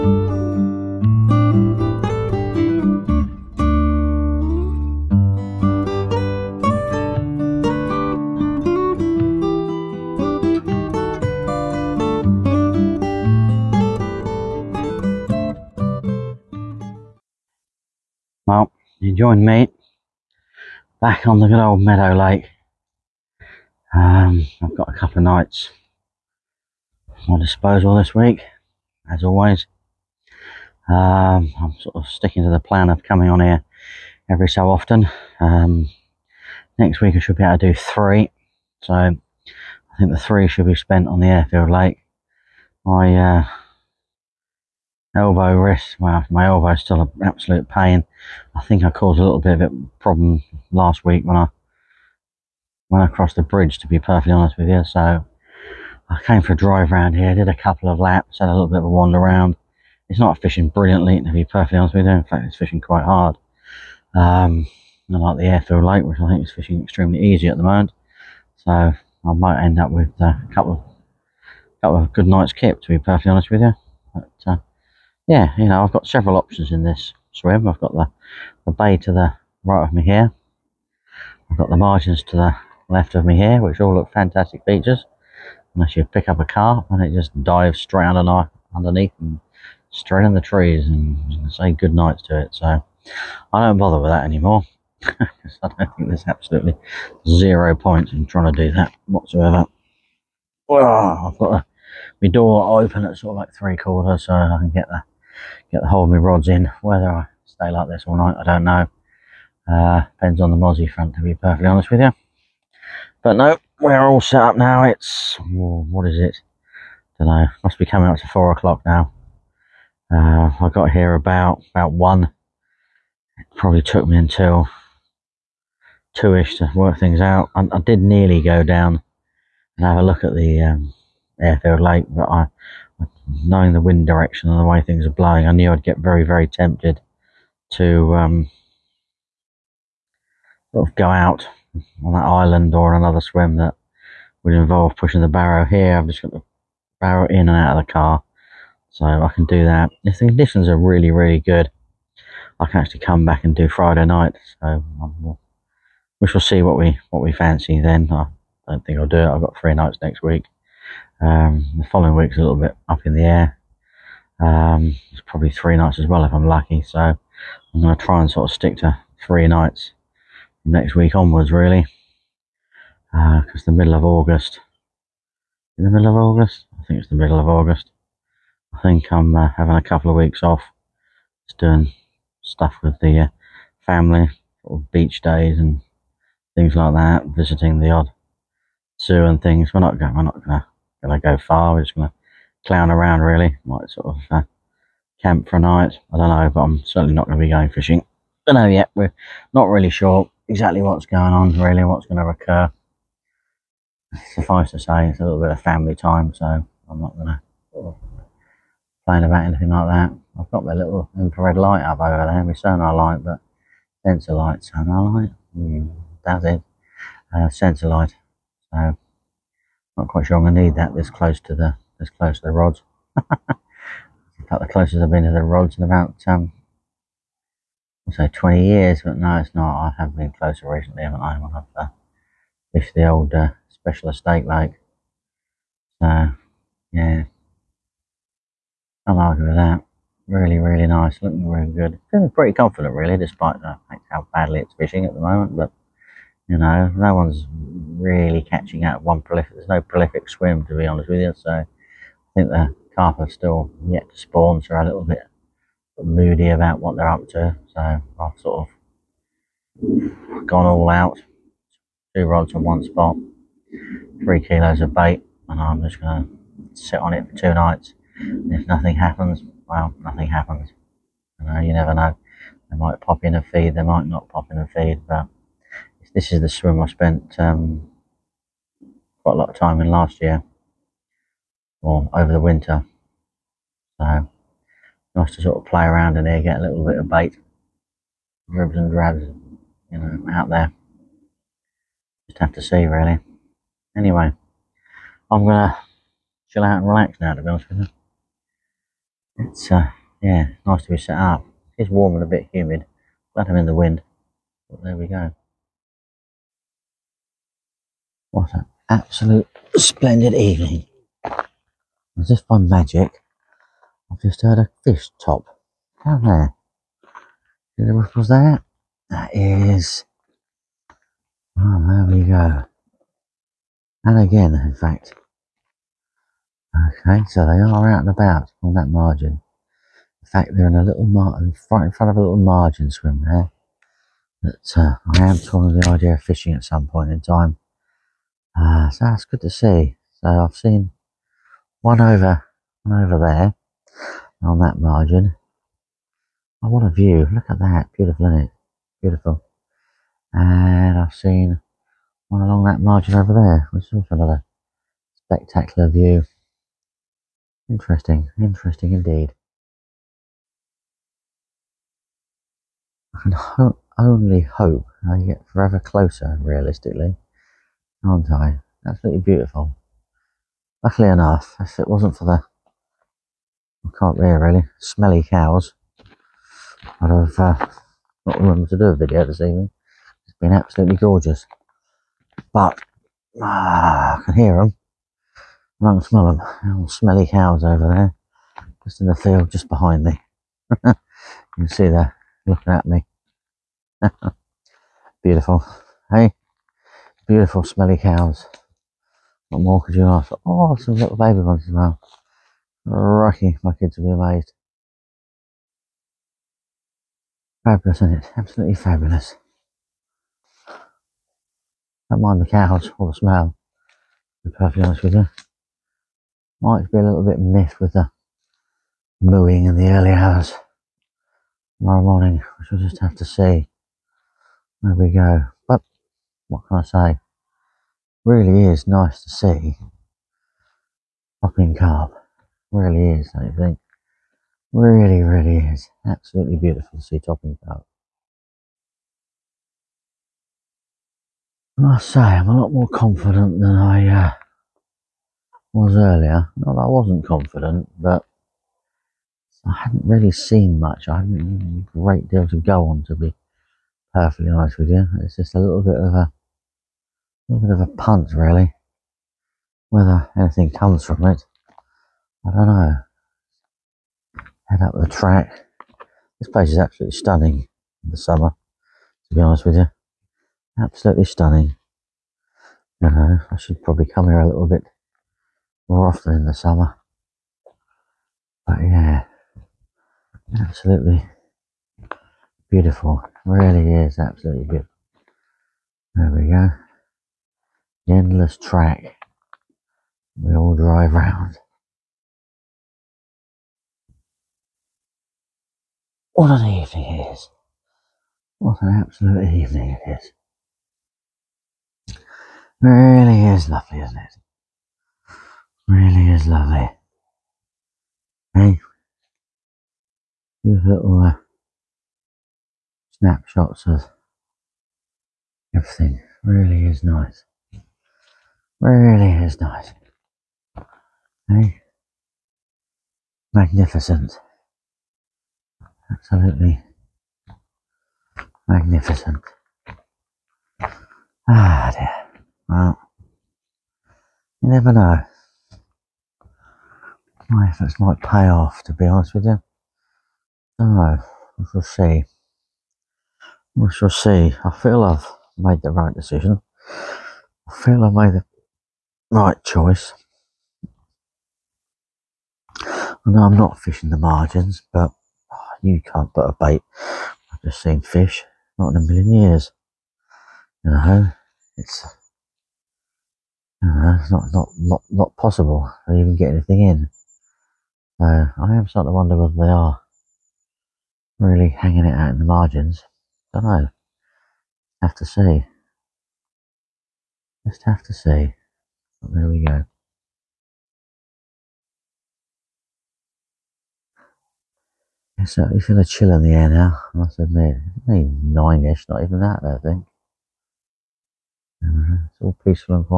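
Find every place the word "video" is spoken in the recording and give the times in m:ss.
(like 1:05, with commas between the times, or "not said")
6:18.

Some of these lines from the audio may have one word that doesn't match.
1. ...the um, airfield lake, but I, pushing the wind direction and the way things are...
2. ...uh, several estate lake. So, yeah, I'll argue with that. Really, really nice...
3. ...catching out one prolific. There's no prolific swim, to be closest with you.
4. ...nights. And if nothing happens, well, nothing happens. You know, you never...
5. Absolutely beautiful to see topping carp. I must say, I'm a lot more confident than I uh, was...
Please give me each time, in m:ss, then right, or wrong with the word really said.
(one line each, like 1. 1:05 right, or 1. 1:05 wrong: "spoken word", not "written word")
1. 2:10 wrong: "knowing", not "pushing"
2. 3:53 wrong: "special", not "several"
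3. 4:08 wrong: "honest", not "closest"
4. 4:27 right
5. 7:16 right.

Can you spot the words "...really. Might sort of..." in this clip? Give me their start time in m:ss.
3:13.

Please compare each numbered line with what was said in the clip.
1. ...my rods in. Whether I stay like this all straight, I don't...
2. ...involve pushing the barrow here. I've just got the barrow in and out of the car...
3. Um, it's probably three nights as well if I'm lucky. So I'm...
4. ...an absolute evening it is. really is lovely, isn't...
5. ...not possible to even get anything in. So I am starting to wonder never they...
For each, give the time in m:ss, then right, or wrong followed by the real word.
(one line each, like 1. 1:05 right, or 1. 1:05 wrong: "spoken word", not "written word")
1. 1:46 wrong: "night", not "straight"
2. 2:24 right
3. 2:44 right
4. 8:18 right
5. 9:25 wrong: "whether", not "never".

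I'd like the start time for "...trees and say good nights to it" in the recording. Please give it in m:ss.
1:30.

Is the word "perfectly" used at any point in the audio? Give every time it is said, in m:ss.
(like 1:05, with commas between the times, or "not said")
0:53, 1:01, 1:12, 1:51, 6:54, 7:34.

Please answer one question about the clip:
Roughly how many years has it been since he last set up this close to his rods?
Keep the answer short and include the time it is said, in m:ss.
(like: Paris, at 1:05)
20, at 3:48.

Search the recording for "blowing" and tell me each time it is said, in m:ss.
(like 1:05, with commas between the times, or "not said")
2:15.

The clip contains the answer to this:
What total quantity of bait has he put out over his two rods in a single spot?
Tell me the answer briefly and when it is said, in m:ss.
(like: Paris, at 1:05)
3 kilos, at 4:24.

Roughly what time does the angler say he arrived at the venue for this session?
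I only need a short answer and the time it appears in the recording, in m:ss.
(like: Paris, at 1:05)
About 1, at 2:00.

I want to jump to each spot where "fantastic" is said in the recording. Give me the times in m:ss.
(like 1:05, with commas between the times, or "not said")
1:24.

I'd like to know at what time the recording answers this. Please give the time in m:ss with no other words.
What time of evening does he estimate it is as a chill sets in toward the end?
9:48.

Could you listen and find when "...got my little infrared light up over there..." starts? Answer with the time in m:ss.
3:30.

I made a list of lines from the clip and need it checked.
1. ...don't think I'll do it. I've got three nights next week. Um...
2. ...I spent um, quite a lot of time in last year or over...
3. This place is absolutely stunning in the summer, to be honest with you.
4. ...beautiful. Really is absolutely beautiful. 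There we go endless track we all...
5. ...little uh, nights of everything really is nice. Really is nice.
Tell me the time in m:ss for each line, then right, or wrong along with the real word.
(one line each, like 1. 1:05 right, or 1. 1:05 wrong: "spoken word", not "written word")
1. 2:38 right
2. 4:36 right
3. 7:46 right
4. 8:02 right
5. 8:30 wrong: "snapshots", not "nights".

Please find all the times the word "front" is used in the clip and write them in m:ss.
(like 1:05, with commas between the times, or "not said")
1:50, 5:31.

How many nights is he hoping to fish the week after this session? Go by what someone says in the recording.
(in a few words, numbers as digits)
3.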